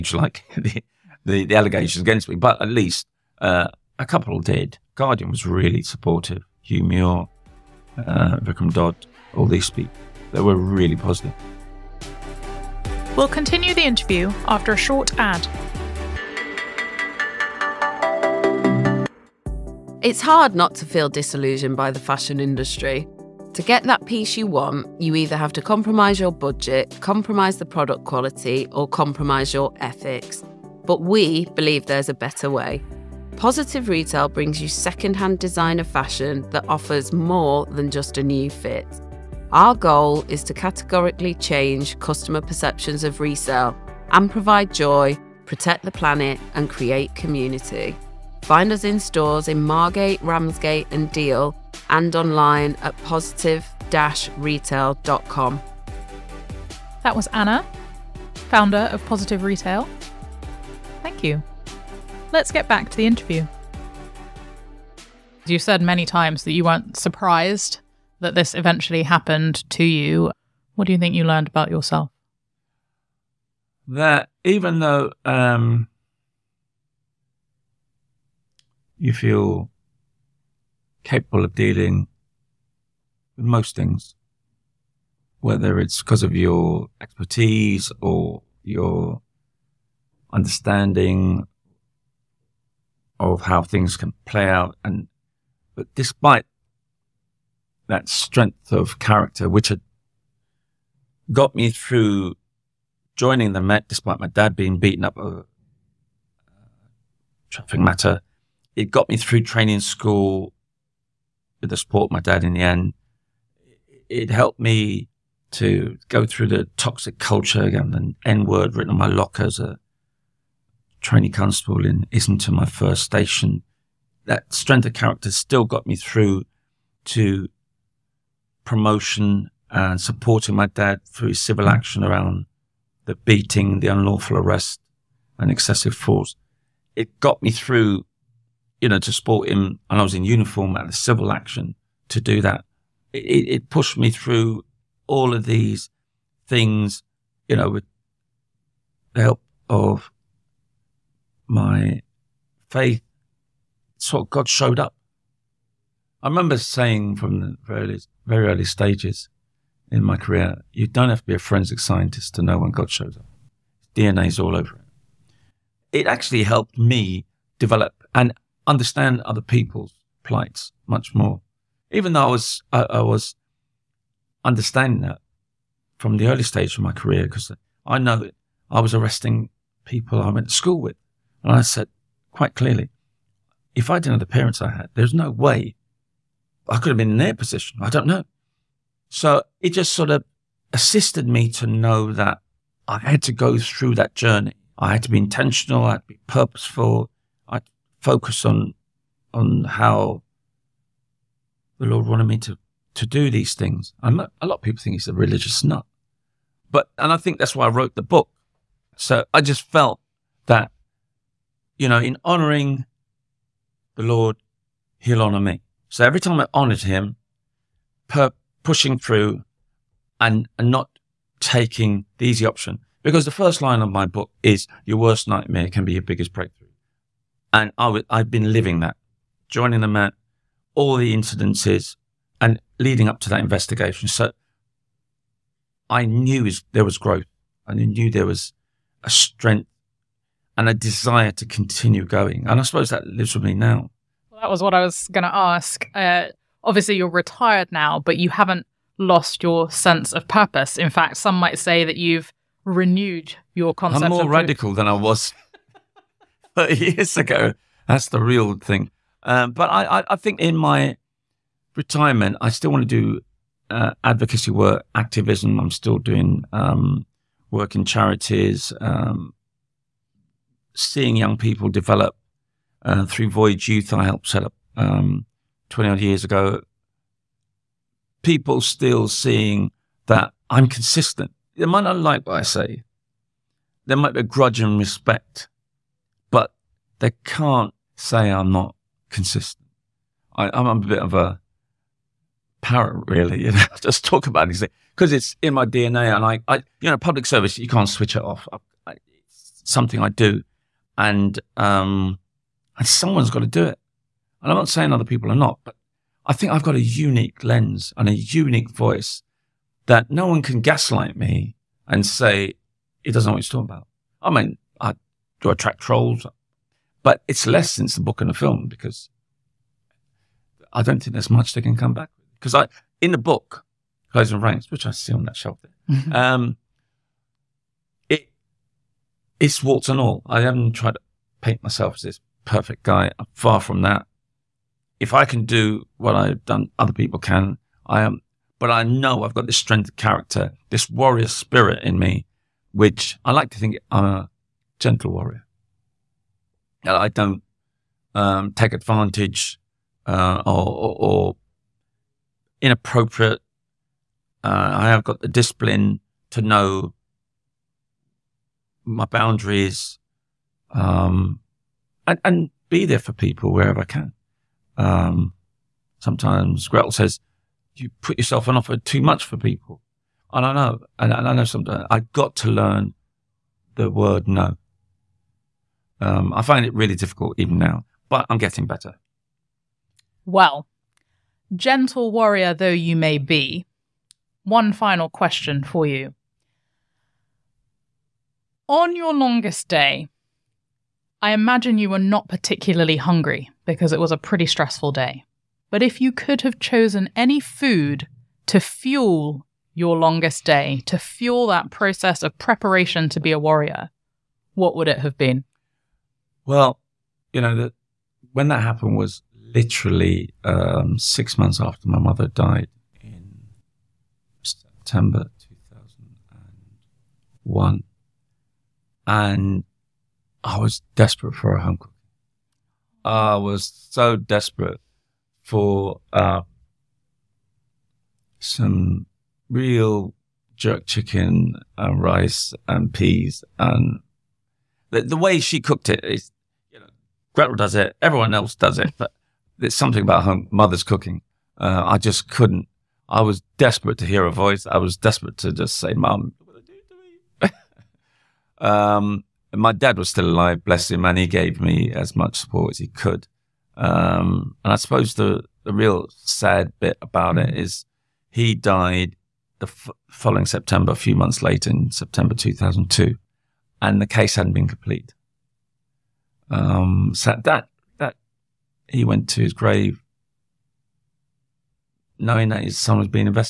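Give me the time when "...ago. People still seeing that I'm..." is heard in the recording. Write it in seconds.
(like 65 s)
276 s.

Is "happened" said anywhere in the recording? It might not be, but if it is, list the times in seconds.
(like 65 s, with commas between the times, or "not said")
69 s, 408 s.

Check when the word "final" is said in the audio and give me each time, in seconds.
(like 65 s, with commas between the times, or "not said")
384 s.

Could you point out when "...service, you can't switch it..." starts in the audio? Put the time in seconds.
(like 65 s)
297 s.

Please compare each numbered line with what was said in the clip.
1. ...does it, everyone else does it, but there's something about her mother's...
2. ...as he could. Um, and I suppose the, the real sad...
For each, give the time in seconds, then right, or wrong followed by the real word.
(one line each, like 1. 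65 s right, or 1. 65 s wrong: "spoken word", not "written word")
1. 437 s right
2. 452 s right.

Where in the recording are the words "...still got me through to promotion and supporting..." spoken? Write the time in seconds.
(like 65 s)
125 s.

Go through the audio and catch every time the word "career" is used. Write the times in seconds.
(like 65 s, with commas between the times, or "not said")
160 s, 176 s.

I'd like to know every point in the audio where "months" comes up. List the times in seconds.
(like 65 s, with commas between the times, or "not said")
411 s, 461 s.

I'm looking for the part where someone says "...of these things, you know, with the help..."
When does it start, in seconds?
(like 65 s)
145 s.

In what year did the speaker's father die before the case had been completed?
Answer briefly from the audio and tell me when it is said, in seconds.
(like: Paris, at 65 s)
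2002, at 462 s.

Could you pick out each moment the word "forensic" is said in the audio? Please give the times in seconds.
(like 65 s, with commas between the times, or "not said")
161 s.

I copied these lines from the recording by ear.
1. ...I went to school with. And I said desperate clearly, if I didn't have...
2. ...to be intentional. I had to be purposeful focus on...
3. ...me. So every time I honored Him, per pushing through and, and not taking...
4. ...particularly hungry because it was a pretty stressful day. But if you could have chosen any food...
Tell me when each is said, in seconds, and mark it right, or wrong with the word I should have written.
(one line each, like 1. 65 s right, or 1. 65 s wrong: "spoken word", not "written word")
1. 180 s wrong: "quite", not "desperate"
2. 195 s right
3. 215 s right
4. 392 s right.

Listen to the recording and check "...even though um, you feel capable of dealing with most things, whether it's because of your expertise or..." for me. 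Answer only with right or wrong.
right.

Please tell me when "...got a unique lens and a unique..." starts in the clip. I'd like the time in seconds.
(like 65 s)
306 s.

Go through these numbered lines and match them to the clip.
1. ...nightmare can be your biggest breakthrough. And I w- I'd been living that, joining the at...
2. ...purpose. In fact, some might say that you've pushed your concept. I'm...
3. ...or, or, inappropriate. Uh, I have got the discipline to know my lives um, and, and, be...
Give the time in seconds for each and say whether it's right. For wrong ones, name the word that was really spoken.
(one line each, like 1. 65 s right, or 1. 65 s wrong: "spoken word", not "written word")
1. 225 s right
2. 250 s wrong: "renewed", not "pushed"
3. 350 s wrong: "boundaries", not "lives".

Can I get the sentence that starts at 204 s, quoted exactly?
I'm a, a lot of people think he's a religious nut, but and I think that's why I wrote the book.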